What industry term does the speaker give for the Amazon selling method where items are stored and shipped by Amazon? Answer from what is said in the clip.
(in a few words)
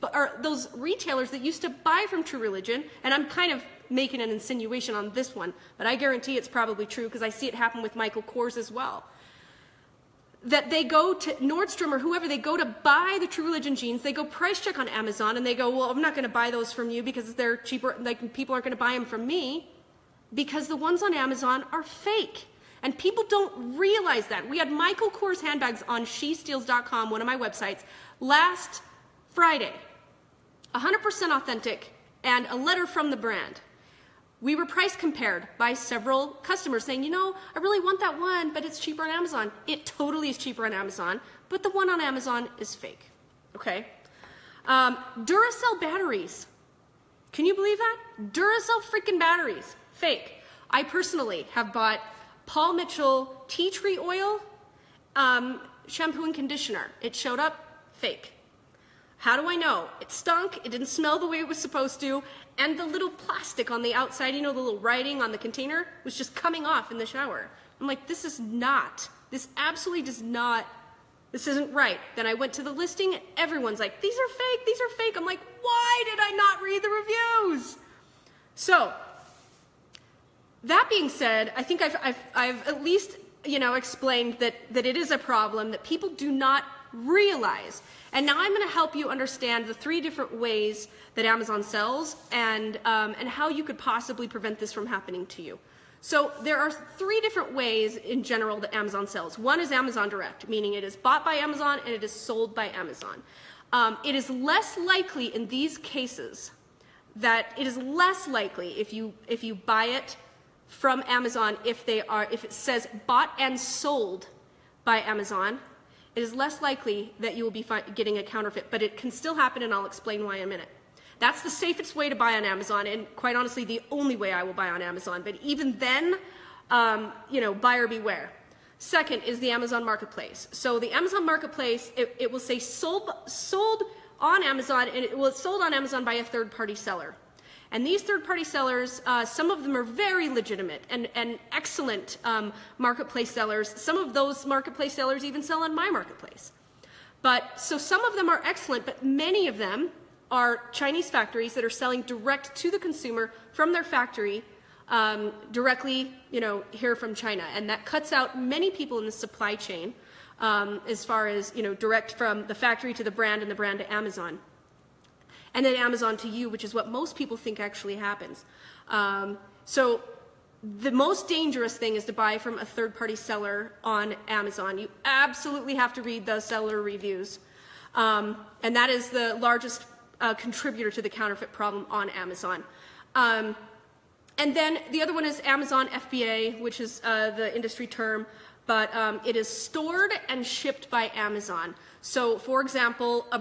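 Amazon FBA.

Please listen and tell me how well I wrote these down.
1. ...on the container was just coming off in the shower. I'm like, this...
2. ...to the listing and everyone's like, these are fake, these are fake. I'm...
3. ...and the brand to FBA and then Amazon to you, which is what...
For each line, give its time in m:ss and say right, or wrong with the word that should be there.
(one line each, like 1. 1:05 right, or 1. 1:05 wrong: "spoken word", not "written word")
1. 1:05 right
2. 1:12 right
3. 2:43 wrong: "Amazon", not "FBA".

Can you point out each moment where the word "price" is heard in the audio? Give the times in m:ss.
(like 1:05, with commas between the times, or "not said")
0:14, 0:34.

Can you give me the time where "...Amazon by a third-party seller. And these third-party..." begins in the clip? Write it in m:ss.
2:15.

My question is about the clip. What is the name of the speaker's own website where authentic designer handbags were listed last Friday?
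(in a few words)
shesteals.com.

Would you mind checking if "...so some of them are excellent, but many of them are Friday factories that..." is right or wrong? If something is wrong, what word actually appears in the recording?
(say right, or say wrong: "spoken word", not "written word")
wrong: "Chinese", not "Friday".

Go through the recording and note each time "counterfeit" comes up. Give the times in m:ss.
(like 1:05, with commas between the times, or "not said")
1:58, 3:01.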